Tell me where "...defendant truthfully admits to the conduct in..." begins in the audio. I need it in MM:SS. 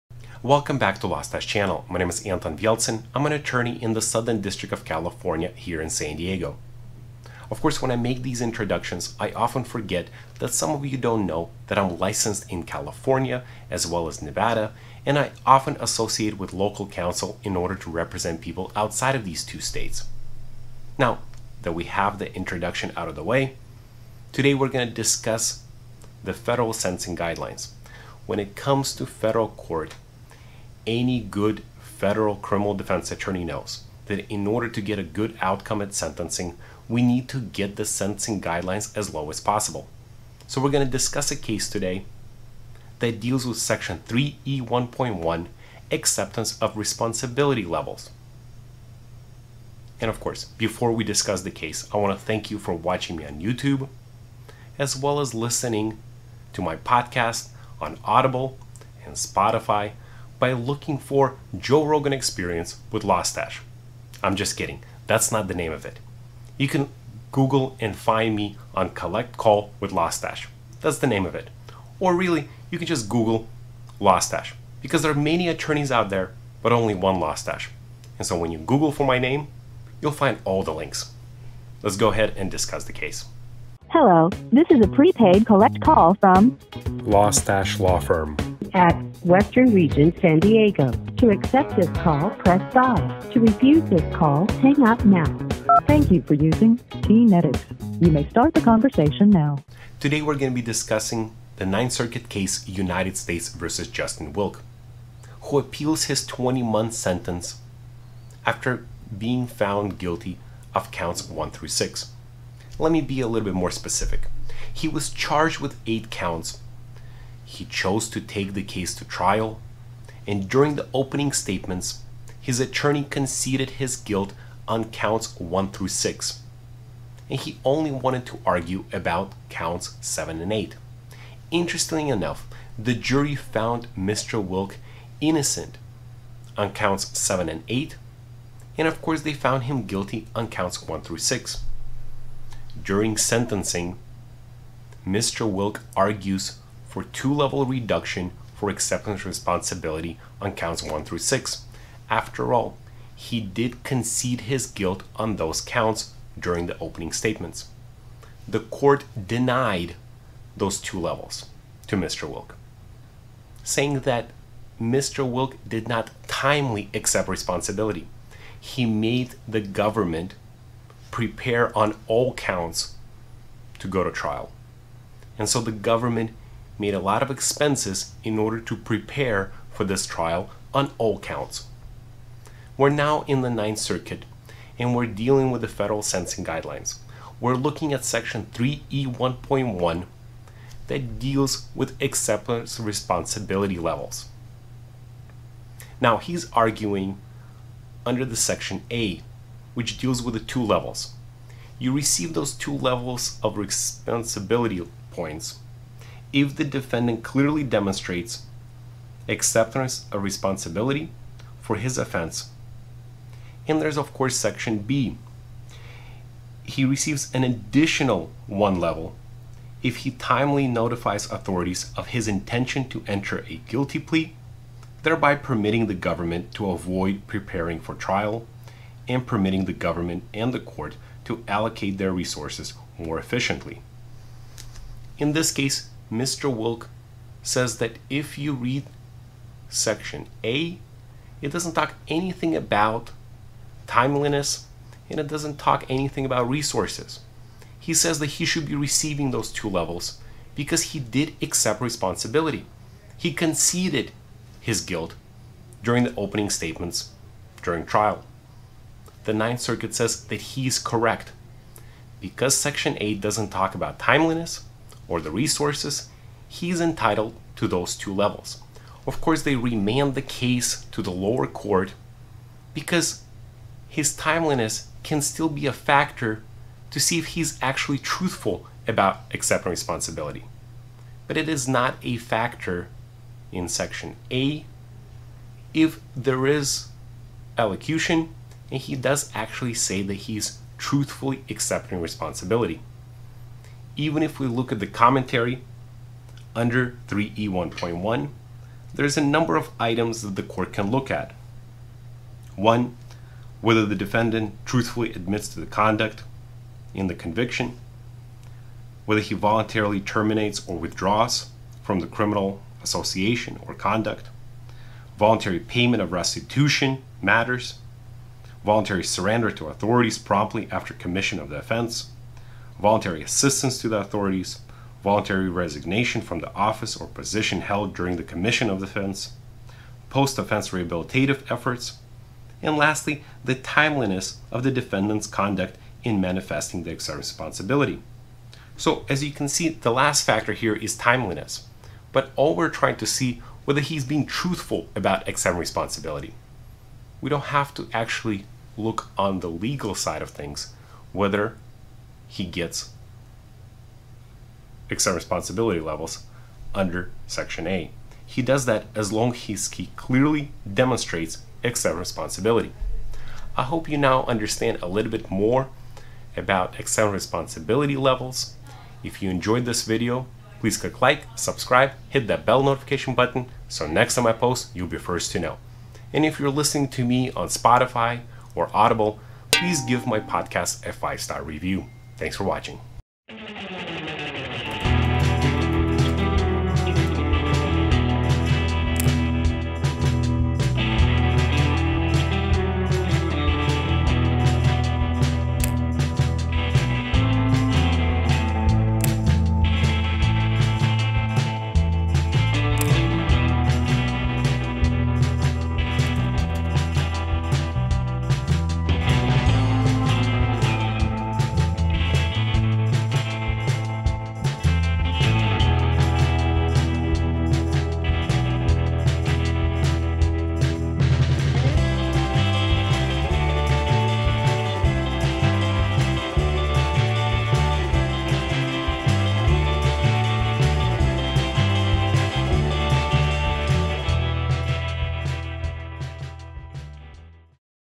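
05:03.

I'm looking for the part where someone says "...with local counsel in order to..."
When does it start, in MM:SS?
00:16.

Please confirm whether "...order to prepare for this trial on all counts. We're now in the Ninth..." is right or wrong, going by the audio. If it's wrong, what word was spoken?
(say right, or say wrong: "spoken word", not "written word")
right.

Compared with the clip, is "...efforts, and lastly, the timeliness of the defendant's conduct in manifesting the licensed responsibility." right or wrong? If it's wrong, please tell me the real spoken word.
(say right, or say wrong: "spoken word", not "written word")
wrong: "exerted", not "licensed".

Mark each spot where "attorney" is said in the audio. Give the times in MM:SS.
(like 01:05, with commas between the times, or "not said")
00:03, 00:33, 01:15, 02:02.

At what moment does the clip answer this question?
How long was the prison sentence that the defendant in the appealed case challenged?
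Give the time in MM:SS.
01:46.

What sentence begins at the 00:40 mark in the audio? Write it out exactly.
So we're going to discuss a case today that deals with section 3E1.1 acceptance of responsibility levels.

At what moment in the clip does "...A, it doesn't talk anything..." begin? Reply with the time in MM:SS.
04:00.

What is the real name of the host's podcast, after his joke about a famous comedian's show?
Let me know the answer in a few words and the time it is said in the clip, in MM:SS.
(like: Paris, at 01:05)
Collect Call with Lawstache, at 01:08.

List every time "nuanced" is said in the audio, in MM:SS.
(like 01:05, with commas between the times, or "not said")
not said.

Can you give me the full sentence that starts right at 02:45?
Wilke did not timely accept responsibility.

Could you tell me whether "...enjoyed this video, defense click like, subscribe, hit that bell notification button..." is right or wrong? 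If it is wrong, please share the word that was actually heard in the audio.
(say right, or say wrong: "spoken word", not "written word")
wrong: "please", not "defense".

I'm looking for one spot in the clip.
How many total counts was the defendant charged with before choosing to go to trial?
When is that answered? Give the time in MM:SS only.
01:55.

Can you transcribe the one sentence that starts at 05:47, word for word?
We don't have to actually look on the legal side of things, whether he gets except responsibility levels under Section A.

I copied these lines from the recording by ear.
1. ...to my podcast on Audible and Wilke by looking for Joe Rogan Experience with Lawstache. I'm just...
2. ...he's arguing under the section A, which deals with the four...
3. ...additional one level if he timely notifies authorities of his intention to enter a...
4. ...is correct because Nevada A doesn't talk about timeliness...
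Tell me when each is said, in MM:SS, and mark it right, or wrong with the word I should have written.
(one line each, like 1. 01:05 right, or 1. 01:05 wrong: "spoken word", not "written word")
1. 00:56 wrong: "Spotify", not "Wilke"
2. 03:16 wrong: "two", not "four"
3. 03:37 right
4. 04:20 wrong: "Section", not "Nevada".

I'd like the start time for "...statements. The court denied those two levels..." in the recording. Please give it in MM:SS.
02:37.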